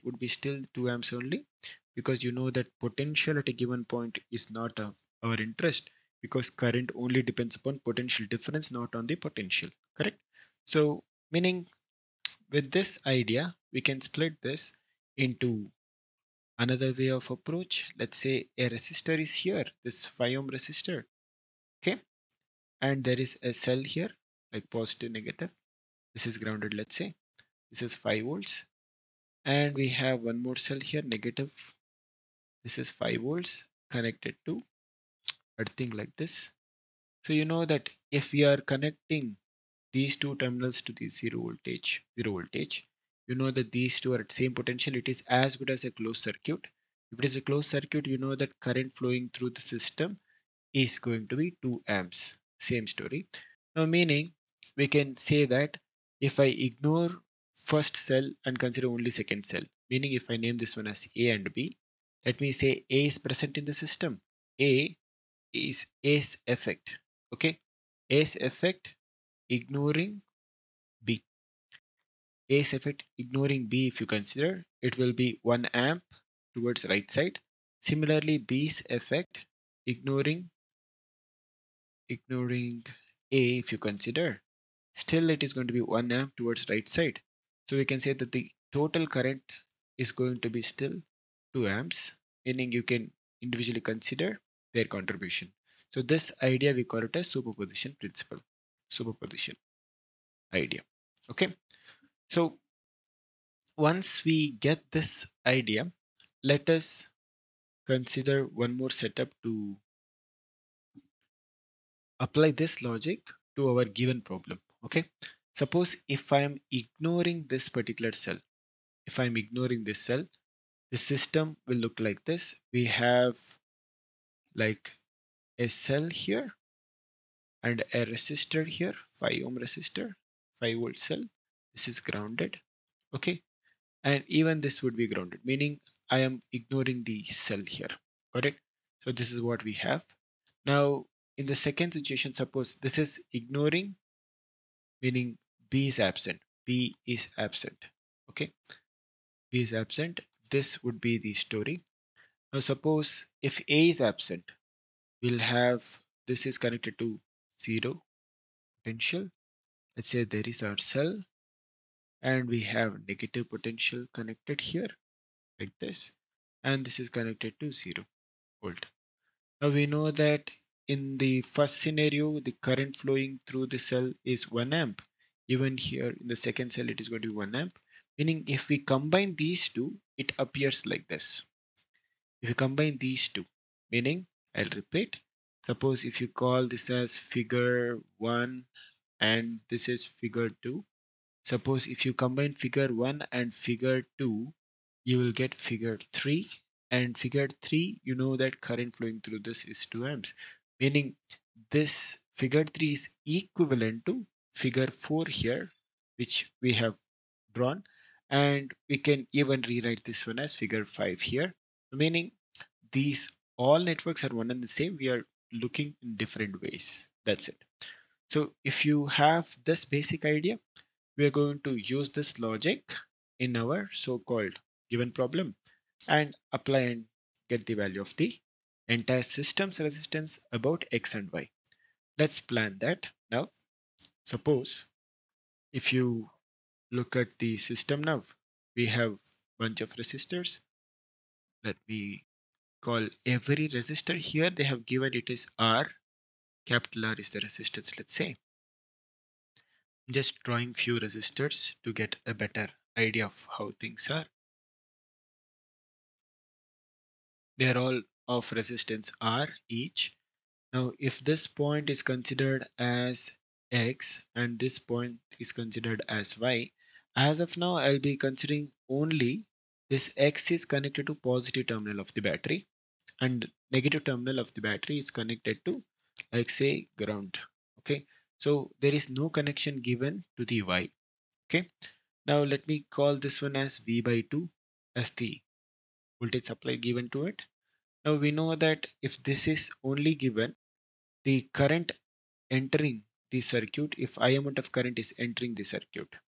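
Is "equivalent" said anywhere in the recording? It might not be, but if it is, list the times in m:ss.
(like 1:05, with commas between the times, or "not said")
3:23.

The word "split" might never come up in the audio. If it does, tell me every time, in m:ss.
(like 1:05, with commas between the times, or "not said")
0:14.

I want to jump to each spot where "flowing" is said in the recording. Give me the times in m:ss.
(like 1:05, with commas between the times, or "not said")
0:49, 2:53, 3:18.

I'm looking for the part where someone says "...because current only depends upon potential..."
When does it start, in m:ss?
0:06.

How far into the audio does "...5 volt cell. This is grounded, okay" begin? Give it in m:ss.
2:10.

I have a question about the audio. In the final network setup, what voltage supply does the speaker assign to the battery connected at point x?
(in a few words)
V/2.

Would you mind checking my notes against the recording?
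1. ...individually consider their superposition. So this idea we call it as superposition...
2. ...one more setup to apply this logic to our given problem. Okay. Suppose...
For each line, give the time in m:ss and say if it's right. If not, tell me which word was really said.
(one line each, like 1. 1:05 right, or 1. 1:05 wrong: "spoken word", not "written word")
1. 1:33 wrong: "contribution", not "superposition"
2. 1:48 right.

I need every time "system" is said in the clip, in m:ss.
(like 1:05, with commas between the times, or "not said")
0:49, 1:03, 2:00, 3:49, 3:57.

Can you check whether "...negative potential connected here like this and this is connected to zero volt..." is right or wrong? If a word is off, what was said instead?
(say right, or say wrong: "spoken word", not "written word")
right.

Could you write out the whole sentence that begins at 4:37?
Okay, so there is no connection given to the y.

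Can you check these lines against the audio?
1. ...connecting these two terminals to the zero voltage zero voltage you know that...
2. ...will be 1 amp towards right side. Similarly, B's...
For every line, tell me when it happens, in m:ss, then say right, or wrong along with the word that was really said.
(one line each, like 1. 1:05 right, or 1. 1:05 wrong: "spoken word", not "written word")
1. 0:38 right
2. 1:14 right.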